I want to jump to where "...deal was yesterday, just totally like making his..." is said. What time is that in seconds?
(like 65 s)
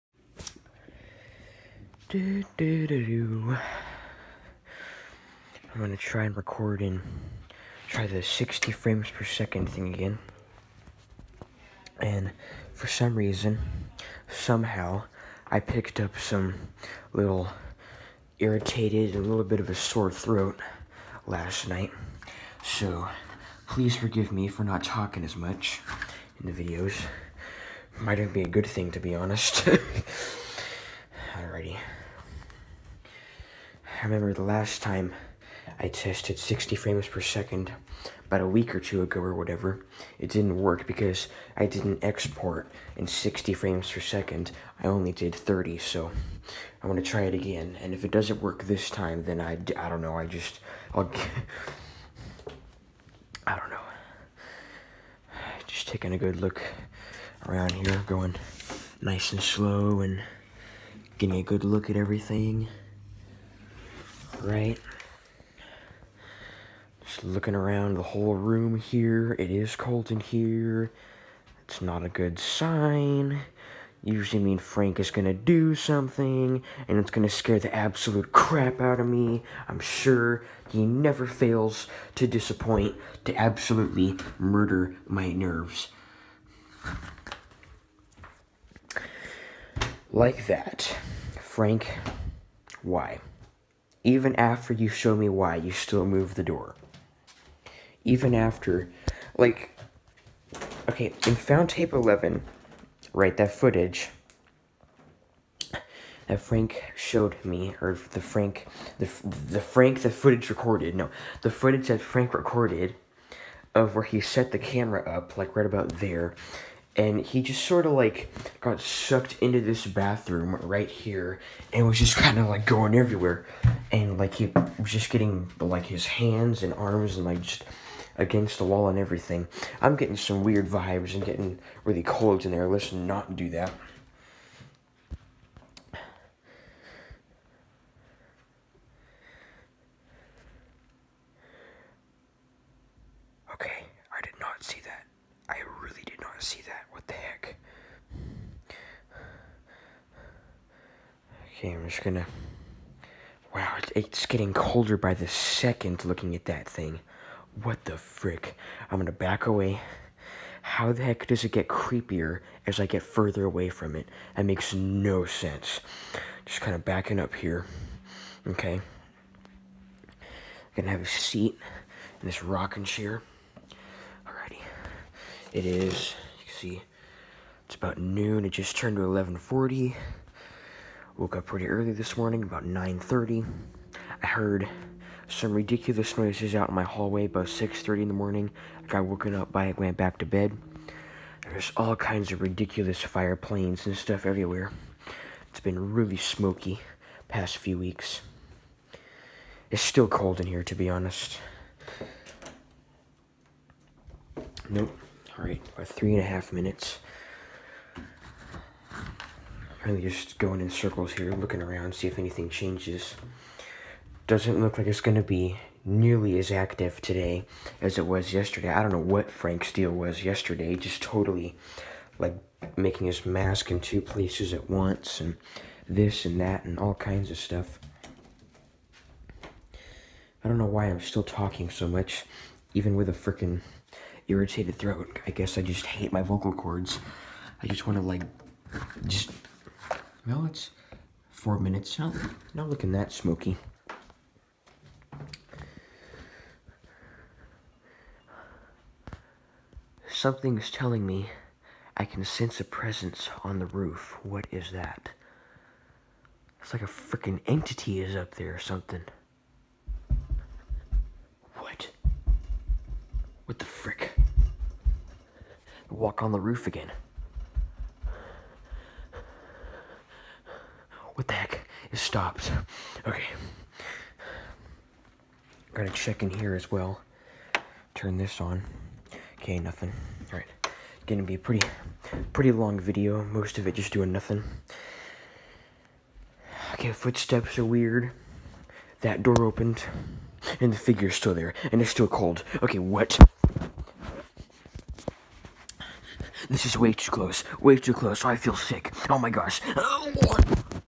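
219 s.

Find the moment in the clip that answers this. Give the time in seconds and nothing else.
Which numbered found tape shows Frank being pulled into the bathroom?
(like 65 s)
101 s.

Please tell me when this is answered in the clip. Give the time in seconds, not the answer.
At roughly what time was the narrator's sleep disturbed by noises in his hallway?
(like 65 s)
187 s.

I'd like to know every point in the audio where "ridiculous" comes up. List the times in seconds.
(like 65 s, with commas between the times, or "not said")
185 s, 192 s.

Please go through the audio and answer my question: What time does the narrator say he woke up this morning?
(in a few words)
9:30.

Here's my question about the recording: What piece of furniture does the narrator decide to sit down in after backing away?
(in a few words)
rocking chair.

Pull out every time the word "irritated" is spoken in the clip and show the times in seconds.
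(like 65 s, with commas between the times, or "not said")
18 s, 234 s.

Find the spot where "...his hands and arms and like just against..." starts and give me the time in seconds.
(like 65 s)
125 s.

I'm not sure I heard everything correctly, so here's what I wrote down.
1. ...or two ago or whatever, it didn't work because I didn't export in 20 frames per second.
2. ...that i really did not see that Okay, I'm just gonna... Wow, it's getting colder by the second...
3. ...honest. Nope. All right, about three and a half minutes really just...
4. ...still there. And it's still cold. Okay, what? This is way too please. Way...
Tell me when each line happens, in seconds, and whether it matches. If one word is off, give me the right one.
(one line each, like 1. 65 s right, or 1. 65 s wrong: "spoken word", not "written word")
1. 38 s wrong: "60", not "20"
2. 144 s right
3. 200 s right
4. 291 s wrong: "close", not "please".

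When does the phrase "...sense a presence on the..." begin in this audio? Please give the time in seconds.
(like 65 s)
252 s.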